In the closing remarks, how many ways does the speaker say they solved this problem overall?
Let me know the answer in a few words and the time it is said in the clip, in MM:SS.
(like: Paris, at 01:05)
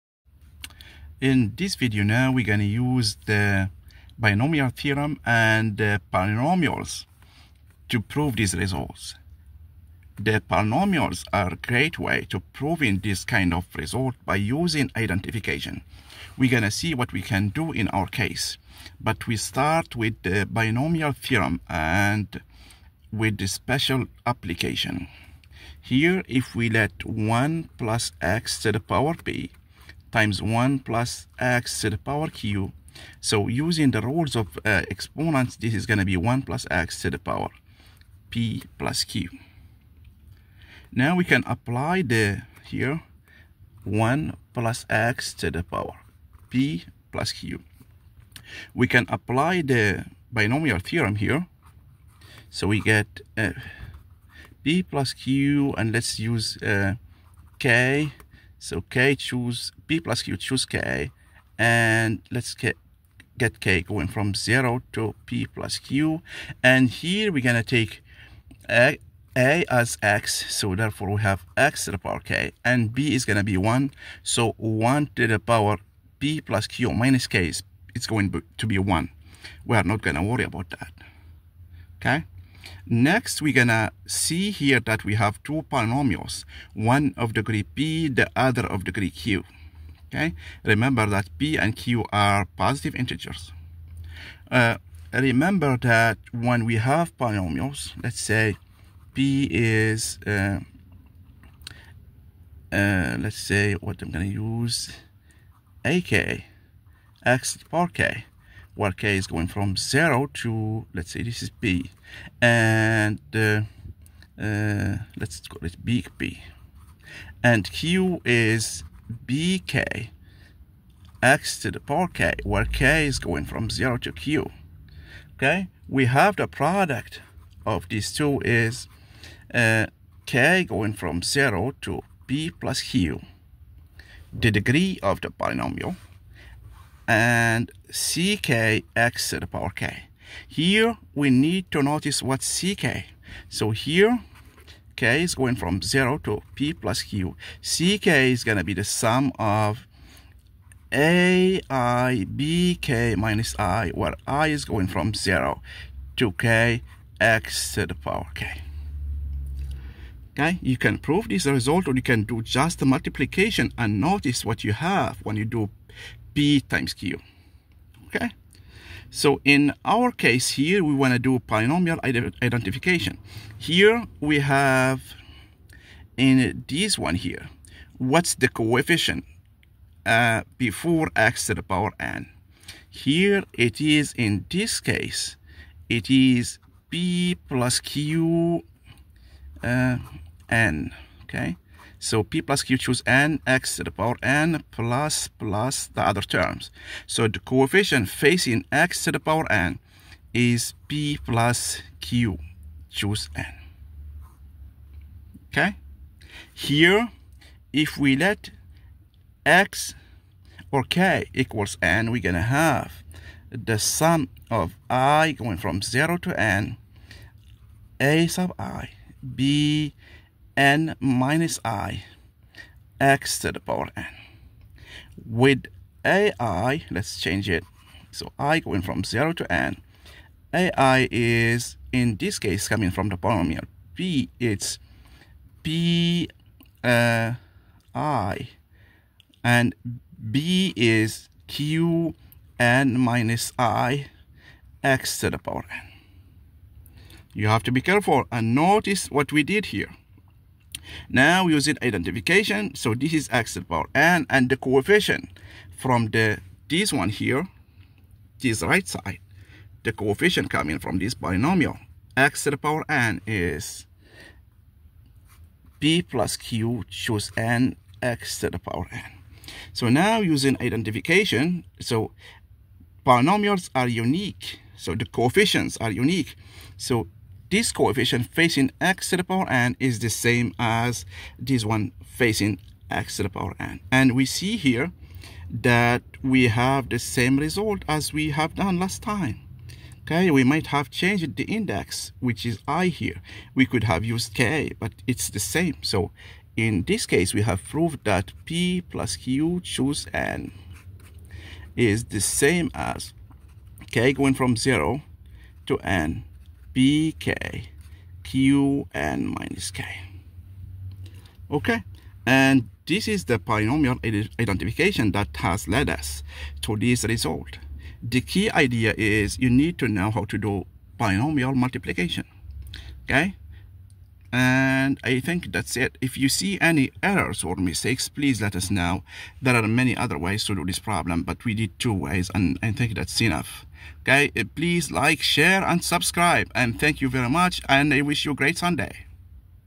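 2, at 05:31.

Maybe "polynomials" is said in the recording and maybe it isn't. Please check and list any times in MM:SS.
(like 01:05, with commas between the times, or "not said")
00:06, 00:10, 01:25, 01:37, 02:15, 02:51, 03:53, 05:13.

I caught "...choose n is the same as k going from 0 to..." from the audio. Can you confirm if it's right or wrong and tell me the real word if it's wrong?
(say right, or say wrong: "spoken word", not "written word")
right.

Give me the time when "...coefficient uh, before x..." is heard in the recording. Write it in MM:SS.
02:58.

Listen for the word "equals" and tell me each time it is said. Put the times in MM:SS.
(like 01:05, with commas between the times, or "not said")
03:31.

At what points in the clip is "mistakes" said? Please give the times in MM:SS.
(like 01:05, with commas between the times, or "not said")
05:27.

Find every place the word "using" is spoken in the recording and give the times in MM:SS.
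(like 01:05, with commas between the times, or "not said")
00:14, 00:33, 04:11, 04:30.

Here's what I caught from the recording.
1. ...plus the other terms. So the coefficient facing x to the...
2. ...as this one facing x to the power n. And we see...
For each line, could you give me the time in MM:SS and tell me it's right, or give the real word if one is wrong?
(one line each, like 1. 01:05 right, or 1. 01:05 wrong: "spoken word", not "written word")
1. 03:15 right
2. 04:40 right.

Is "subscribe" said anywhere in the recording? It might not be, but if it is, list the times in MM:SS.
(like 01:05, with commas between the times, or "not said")
05:35.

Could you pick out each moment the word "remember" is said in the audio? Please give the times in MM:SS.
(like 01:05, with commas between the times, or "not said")
01:30, 01:35.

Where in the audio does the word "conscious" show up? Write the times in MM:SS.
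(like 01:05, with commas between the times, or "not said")
not said.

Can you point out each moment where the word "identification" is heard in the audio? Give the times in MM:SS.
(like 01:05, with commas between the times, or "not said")
00:14, 02:52, 04:11, 04:30, 05:14.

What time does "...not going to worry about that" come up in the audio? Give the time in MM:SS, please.
01:19.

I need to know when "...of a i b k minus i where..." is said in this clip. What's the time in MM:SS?
02:29.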